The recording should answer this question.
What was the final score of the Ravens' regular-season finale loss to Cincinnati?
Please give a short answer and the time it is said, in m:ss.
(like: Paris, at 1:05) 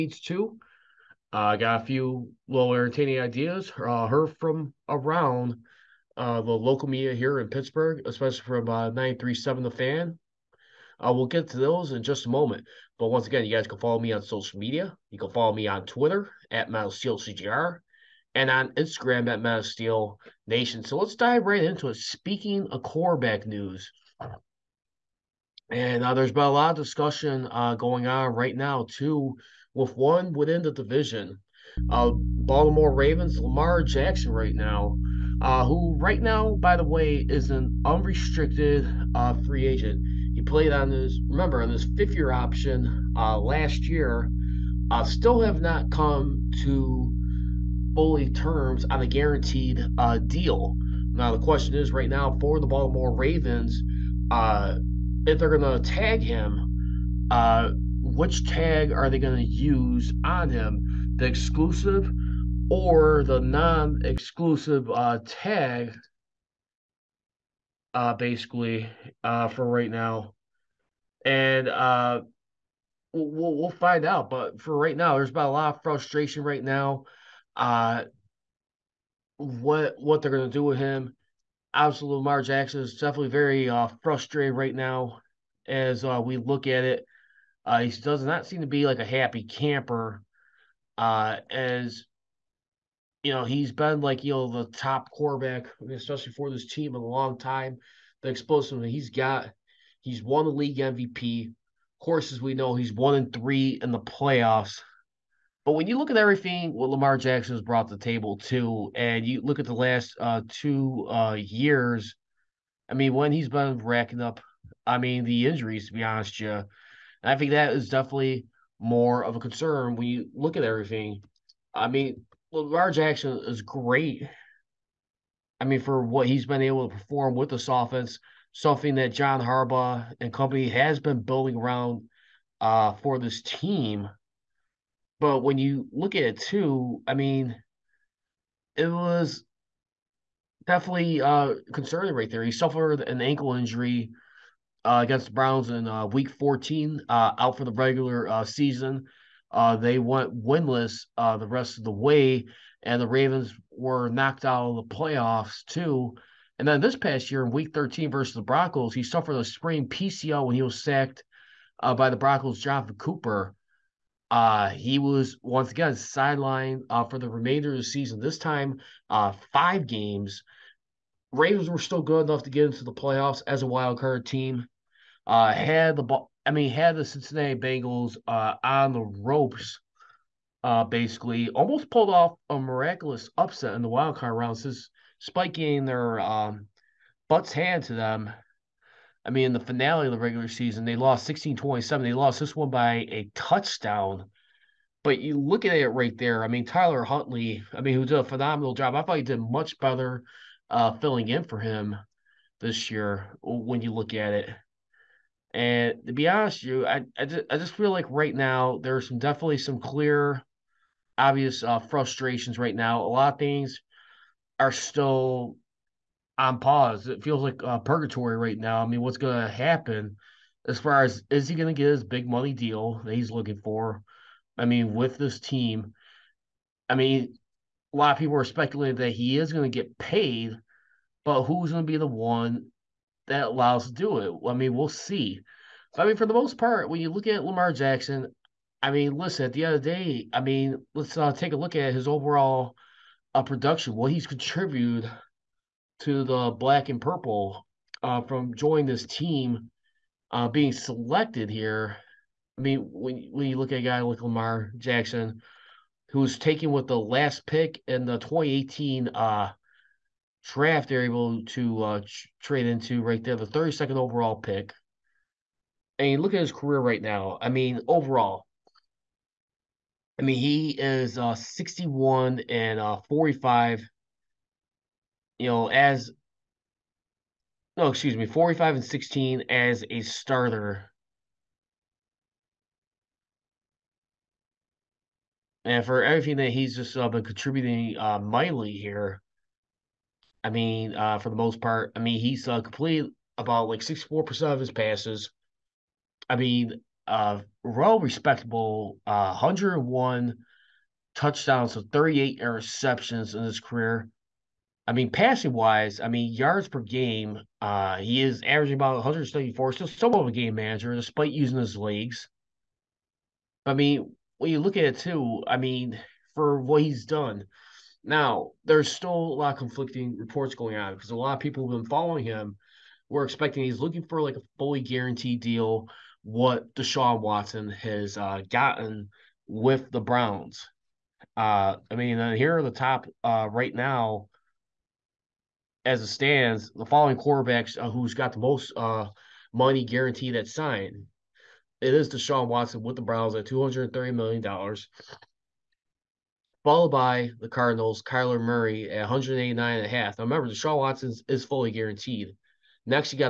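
16-27, at 3:11.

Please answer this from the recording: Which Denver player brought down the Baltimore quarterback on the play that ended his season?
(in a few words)
Jonathan Cooper.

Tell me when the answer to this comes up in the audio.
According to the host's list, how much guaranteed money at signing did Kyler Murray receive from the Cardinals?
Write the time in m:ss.
5:49.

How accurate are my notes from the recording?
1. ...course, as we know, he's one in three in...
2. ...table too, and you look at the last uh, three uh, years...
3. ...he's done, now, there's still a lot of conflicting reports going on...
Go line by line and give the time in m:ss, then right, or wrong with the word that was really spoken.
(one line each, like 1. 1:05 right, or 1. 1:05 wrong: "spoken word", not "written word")
1. 1:42 right
2. 1:48 wrong: "two", not "three"
3. 5:16 right.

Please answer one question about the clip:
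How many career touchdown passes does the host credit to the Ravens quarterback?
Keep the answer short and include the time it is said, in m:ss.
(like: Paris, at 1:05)
101, at 4:59.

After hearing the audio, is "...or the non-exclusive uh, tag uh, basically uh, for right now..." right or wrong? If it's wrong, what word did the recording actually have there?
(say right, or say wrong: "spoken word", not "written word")
right.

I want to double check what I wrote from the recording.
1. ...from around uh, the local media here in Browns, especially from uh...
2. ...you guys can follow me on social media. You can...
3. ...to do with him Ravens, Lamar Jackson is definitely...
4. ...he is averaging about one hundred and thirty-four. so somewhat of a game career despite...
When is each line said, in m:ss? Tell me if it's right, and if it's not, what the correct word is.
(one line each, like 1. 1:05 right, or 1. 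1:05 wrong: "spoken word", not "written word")
1. 0:04 wrong: "Pittsburgh", not "Browns"
2. 0:13 right
3. 1:20 wrong: "Absolutely", not "Ravens"
4. 5:07 wrong: "manager", not "career".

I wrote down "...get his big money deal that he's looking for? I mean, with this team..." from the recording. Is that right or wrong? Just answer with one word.
right.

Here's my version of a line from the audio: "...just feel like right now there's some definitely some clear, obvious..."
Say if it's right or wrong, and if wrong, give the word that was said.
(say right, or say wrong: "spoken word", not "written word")
right.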